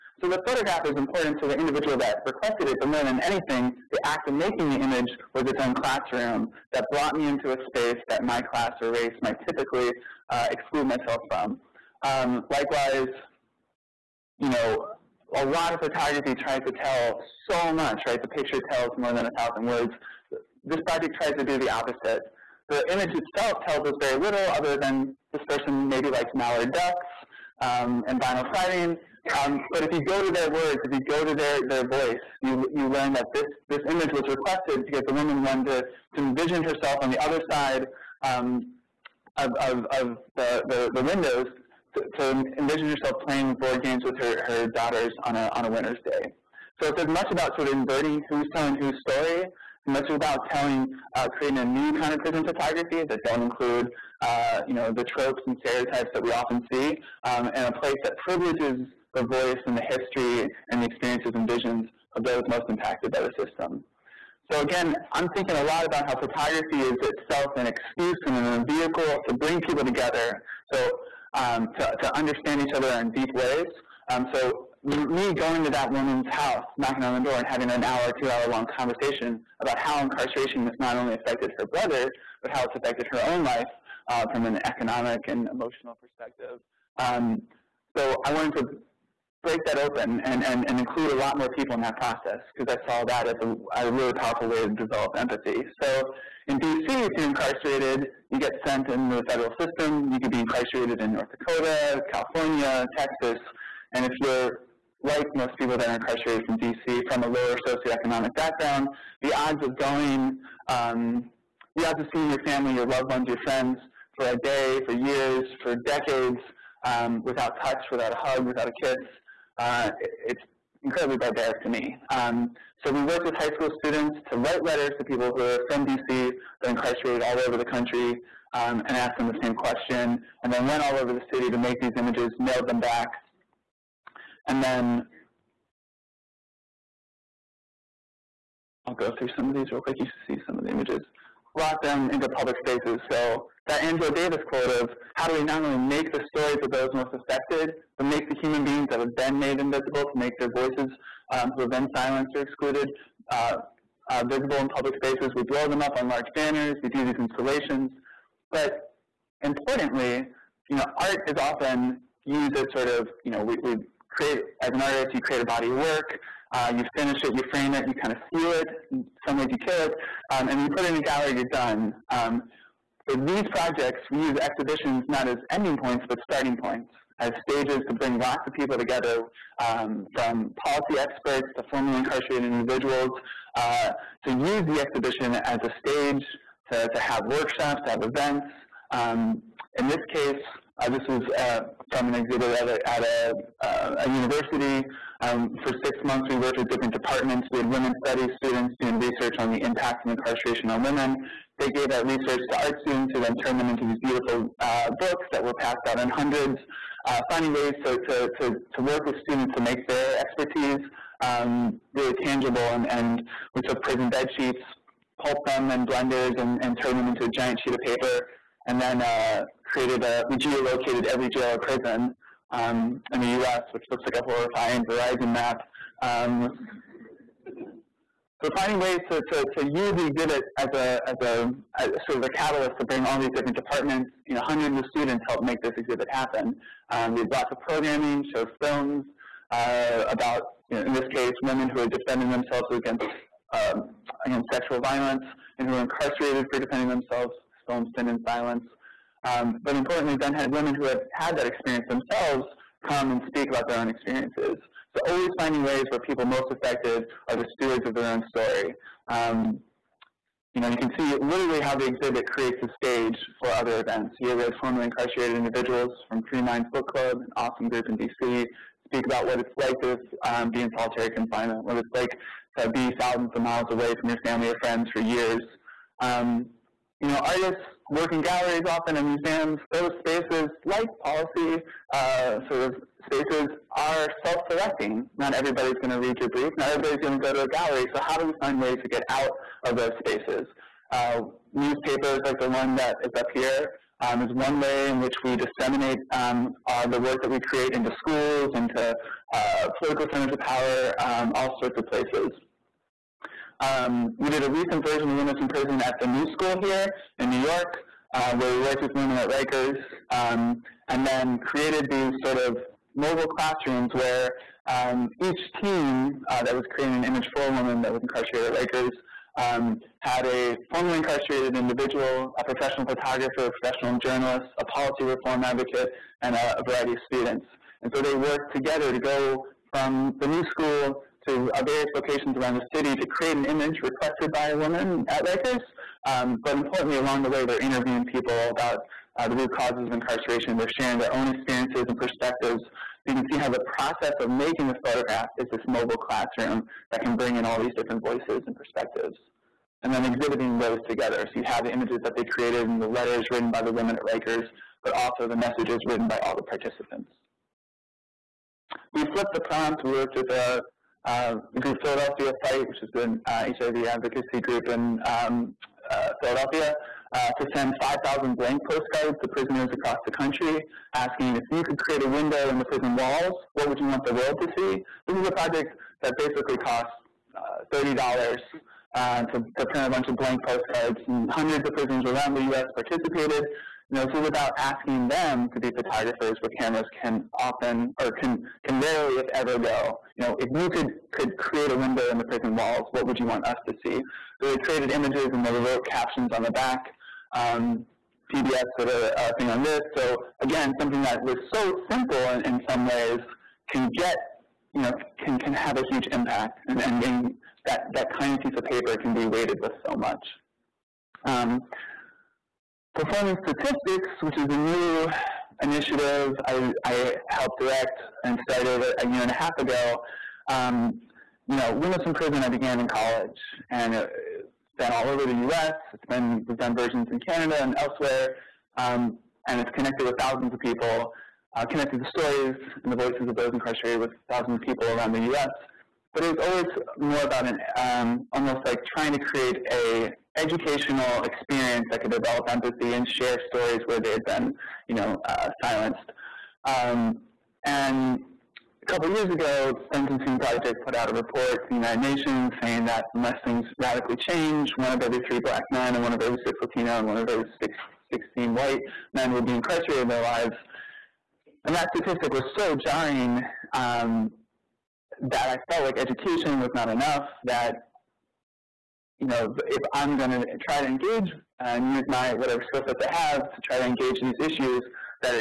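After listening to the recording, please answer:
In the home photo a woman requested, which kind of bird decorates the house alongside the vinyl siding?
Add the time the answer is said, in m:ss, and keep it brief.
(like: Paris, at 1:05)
Mallard ducks, at 0:26.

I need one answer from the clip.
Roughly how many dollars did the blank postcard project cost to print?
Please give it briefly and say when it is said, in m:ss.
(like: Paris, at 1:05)
$30, at 6:17.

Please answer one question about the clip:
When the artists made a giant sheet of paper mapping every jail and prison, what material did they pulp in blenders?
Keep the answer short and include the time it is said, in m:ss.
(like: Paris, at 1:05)
Prison bed sheets, at 3:33.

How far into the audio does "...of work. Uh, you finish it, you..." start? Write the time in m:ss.
2:45.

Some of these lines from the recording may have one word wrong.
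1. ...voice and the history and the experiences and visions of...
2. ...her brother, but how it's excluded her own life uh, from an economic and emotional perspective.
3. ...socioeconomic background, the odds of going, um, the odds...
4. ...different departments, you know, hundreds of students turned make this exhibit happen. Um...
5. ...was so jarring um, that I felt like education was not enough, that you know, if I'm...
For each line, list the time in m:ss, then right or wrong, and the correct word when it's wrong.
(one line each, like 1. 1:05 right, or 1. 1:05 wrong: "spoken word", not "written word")
1. 0:59 right
2. 1:21 wrong: "affected", not "excluded"
3. 1:47 right
4. 3:53 wrong: "helped", not "turned"
5. 7:42 right.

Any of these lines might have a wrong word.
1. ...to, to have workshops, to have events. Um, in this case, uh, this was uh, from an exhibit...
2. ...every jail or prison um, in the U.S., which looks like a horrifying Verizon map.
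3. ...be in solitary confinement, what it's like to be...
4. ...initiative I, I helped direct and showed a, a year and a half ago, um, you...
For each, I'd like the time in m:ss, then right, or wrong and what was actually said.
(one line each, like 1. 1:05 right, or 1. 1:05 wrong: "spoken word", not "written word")
1. 3:06 right
2. 3:41 right
3. 4:30 right
4. 6:55 wrong: "started", not "showed".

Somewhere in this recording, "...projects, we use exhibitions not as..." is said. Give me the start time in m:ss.
2:53.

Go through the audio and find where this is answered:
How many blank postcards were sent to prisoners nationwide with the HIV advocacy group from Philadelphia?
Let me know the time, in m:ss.
6:07.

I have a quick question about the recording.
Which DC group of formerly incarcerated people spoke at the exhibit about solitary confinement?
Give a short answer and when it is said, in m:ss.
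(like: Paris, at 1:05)
Free Minds Book Club, at 4:26.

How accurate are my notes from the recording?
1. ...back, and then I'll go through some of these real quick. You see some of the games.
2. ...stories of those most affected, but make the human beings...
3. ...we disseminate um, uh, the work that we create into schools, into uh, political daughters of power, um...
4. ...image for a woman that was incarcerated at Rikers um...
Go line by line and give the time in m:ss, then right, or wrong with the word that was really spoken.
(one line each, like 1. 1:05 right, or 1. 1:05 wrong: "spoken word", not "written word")
1. 2:12 wrong: "images", not "games"
2. 2:26 right
3. 4:55 wrong: "centers", not "daughters"
4. 5:17 right.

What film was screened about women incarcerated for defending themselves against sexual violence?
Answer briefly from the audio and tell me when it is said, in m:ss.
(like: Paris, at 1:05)
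Sin and Silence, at 4:07.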